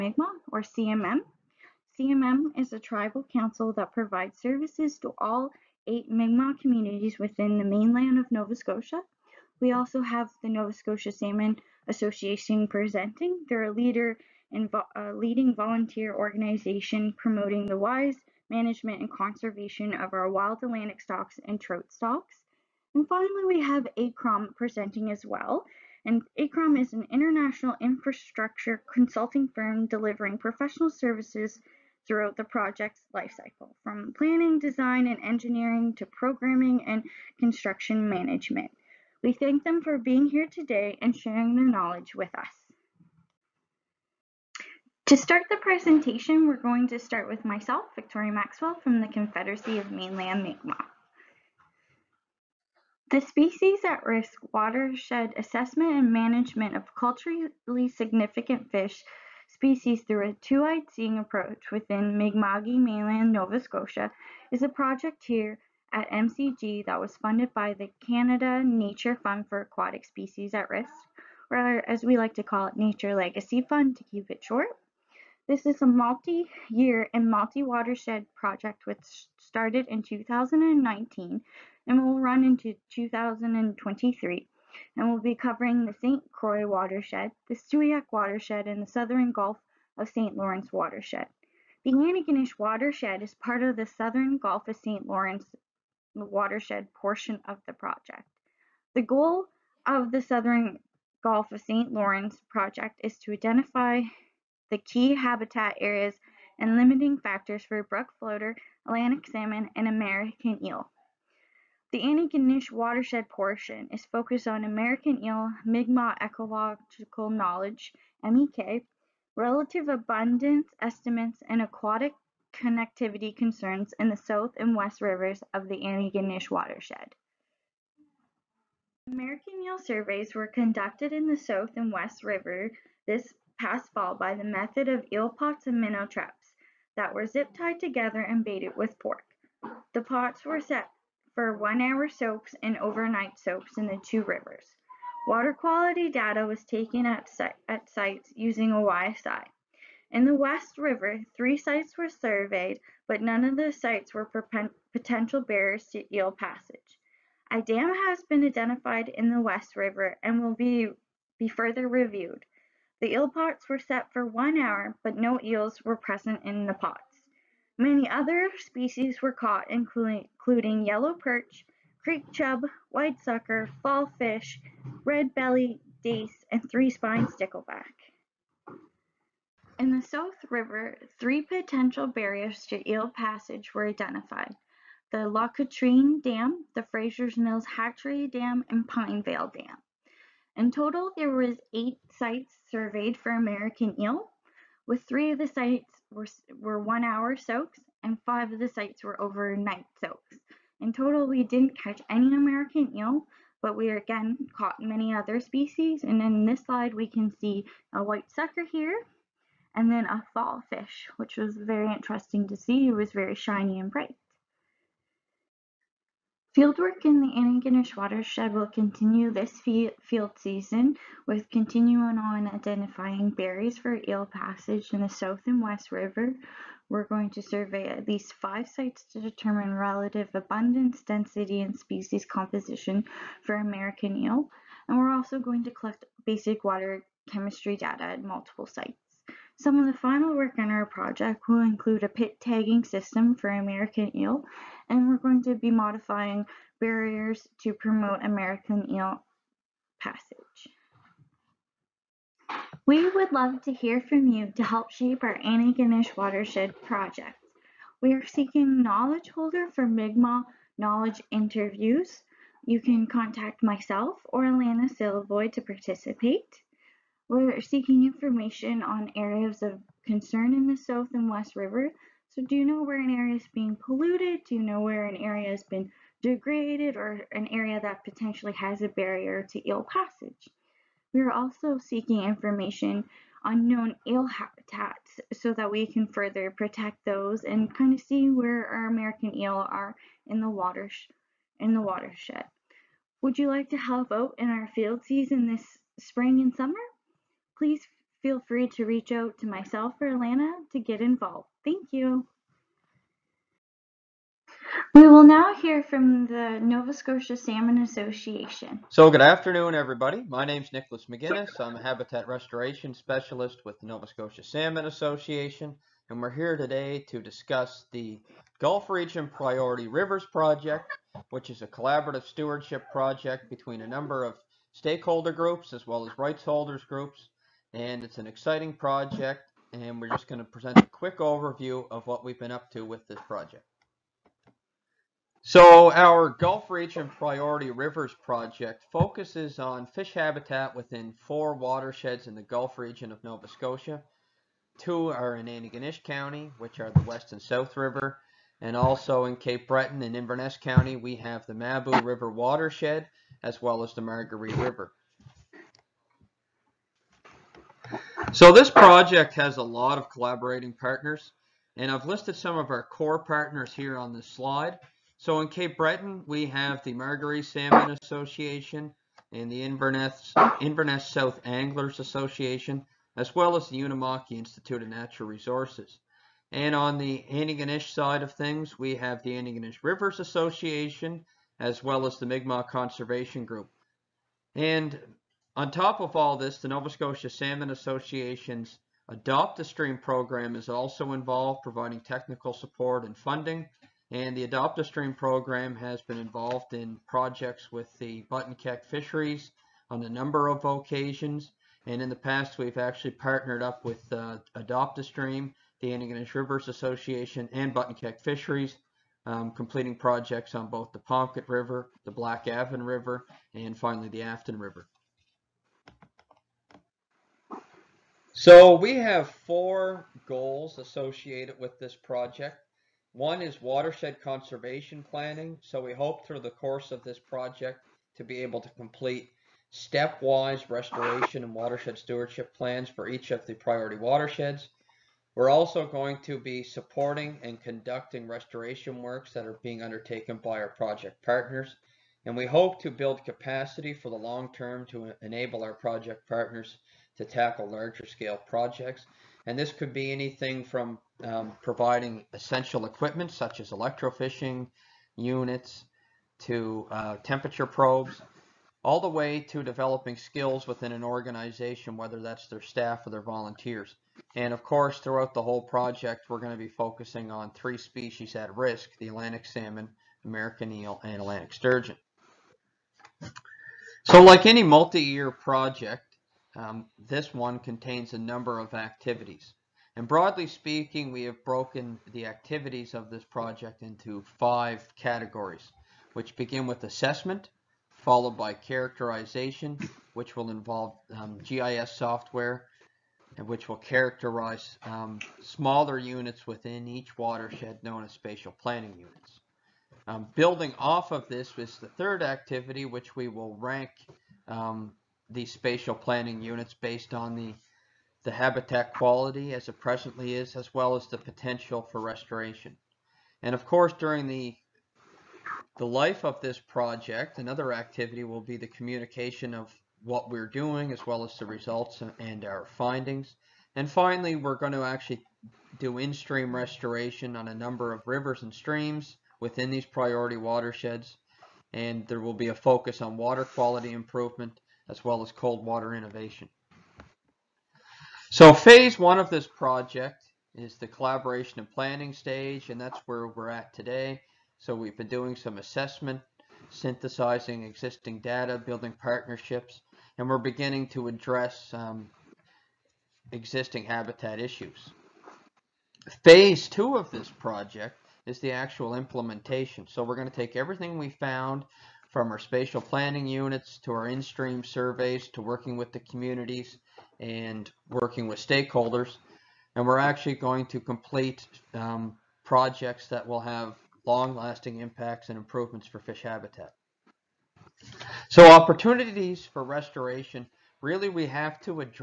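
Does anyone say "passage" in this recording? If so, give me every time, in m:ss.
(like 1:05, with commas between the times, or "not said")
2:36, 3:03, 3:44, 4:09, 4:39.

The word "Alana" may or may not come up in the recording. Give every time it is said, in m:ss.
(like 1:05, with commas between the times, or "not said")
4:24, 5:00.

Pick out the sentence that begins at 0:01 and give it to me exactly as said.
CMM is a tribal council that provides services to all eight Mi'kmaq communities within the mainland of Nova Scotia.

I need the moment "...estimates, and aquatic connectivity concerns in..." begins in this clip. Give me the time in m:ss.
2:00.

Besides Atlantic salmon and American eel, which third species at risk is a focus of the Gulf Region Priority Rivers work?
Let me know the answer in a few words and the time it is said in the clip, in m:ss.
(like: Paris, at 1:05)
Atlantic sturgeon, at 7:51.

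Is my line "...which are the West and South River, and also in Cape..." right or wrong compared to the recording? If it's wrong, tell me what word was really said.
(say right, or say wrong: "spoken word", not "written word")
right.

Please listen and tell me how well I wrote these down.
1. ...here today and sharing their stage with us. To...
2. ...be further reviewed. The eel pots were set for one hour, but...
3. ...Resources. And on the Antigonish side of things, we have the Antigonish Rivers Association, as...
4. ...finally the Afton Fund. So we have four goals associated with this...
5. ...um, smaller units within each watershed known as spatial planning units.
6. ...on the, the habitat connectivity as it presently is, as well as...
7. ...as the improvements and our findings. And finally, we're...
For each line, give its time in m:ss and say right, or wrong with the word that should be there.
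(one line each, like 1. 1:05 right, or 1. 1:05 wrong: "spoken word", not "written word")
1. 0:40 wrong: "knowledge", not "stage"
2. 2:41 right
3. 6:15 right
4. 6:53 wrong: "River", not "Fund"
5. 8:14 right
6. 8:27 wrong: "quality", not "connectivity"
7. 8:41 wrong: "results", not "improvements".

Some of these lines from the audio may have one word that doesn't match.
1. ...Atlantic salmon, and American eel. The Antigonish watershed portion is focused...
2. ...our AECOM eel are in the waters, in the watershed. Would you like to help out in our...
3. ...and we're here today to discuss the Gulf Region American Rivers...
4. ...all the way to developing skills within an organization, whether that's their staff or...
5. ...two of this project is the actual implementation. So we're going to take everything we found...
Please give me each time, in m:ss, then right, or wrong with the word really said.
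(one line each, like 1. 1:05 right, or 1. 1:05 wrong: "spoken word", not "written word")
1. 1:48 right
2. 4:48 wrong: "American", not "AECOM"
3. 5:16 wrong: "Priority", not "American"
4. 7:38 right
5. 9:16 right.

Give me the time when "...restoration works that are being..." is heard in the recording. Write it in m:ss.
7:18.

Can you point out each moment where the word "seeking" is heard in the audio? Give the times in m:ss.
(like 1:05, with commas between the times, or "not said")
4:18, 4:27, 4:41.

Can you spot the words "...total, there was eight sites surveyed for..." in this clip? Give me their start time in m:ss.
3:10.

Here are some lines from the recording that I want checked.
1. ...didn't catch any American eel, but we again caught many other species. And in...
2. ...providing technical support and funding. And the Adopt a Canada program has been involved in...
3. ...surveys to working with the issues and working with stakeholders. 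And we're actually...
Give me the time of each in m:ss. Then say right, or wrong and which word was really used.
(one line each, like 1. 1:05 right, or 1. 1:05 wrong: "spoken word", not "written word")
1. 3:21 right
2. 6:31 wrong: "Stream", not "Canada"
3. 9:24 wrong: "communities", not "issues".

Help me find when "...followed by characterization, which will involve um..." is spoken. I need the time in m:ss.
8:07.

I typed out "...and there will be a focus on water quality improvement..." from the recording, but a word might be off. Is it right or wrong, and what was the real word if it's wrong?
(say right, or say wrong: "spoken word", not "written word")
right.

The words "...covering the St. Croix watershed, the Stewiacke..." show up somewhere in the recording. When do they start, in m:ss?
1:25.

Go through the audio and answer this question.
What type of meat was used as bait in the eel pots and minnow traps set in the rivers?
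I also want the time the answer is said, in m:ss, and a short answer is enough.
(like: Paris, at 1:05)
Pork, at 2:18.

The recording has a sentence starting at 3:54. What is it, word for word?
And we're also going to collect basic water chemistry data at multiple sites.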